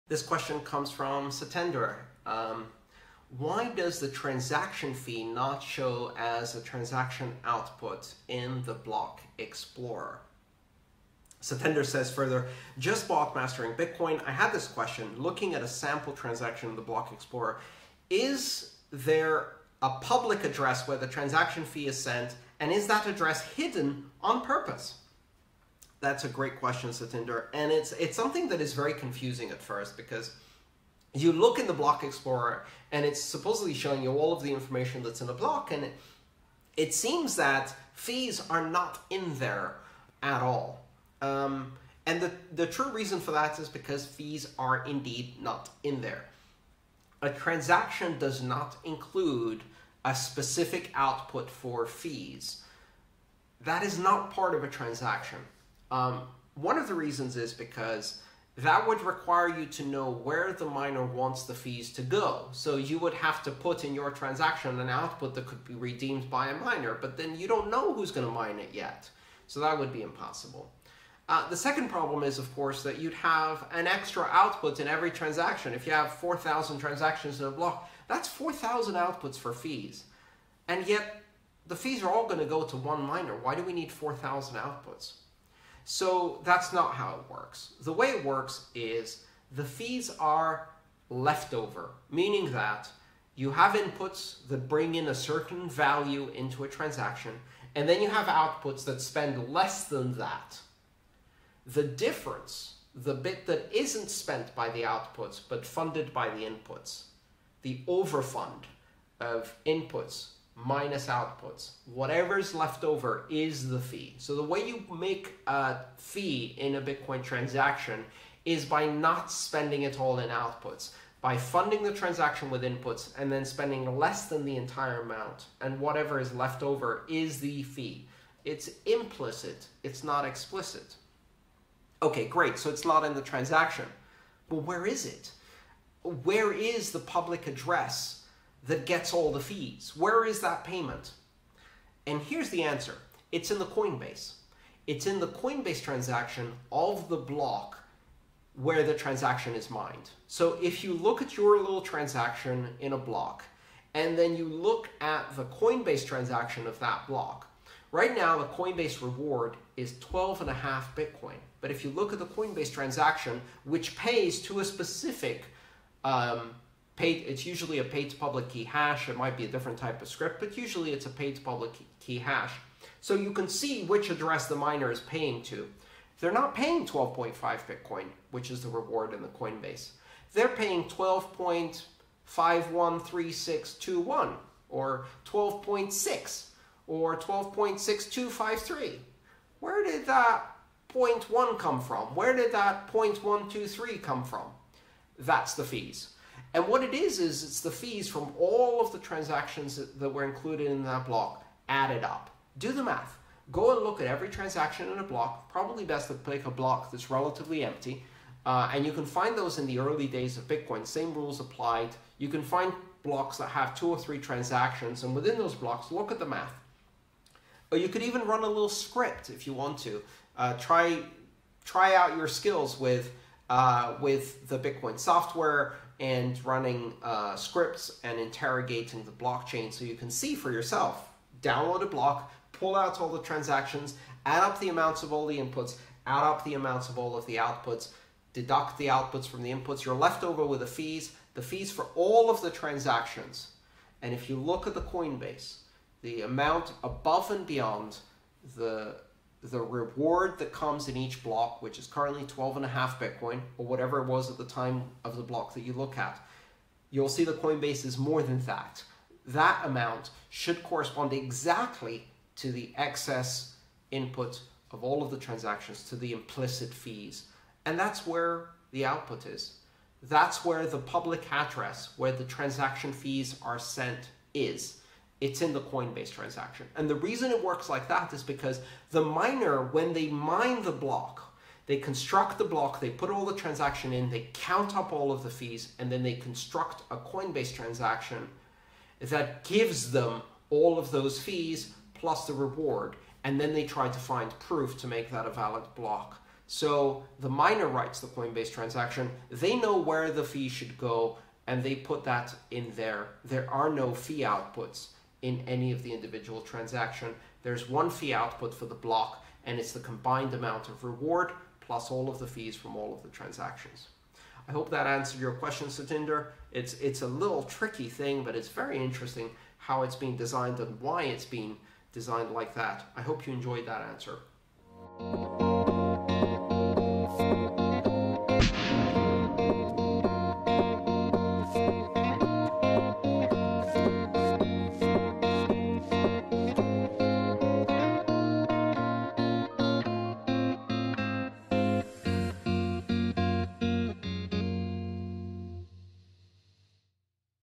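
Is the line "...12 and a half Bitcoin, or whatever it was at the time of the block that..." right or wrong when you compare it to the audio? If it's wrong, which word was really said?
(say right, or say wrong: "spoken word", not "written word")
right.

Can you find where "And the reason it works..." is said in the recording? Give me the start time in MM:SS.
04:36.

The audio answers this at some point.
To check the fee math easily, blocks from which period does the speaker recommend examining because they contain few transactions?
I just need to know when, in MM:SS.
03:29.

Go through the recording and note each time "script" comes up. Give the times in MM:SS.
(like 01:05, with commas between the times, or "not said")
02:50, 03:38, 03:47.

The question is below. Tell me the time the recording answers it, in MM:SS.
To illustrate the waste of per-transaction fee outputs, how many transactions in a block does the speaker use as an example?
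01:16.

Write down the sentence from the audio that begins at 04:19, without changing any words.
That amount should correspond exactly to the excess input of all of the transactions, to the implicit fees.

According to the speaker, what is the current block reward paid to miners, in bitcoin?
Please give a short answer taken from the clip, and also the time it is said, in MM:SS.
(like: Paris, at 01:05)
12.5, at 02:39.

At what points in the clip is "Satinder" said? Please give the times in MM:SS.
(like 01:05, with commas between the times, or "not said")
00:01, 00:11, 00:26, 05:15.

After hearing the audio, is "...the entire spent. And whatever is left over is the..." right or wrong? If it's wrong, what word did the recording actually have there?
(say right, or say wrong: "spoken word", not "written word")
wrong: "amount", not "spent".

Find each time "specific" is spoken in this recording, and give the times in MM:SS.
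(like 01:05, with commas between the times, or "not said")
00:50, 02:44.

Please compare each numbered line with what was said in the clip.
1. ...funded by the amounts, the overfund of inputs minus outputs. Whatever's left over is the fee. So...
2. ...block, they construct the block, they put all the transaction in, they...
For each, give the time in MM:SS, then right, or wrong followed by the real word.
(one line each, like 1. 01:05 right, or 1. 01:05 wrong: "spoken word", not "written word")
1. 01:45 wrong: "inputs", not "amounts"
2. 04:40 right.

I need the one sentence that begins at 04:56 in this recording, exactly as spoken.
So the miner writes the Coinbase transaction, they know where the fee should go, and they put that in there.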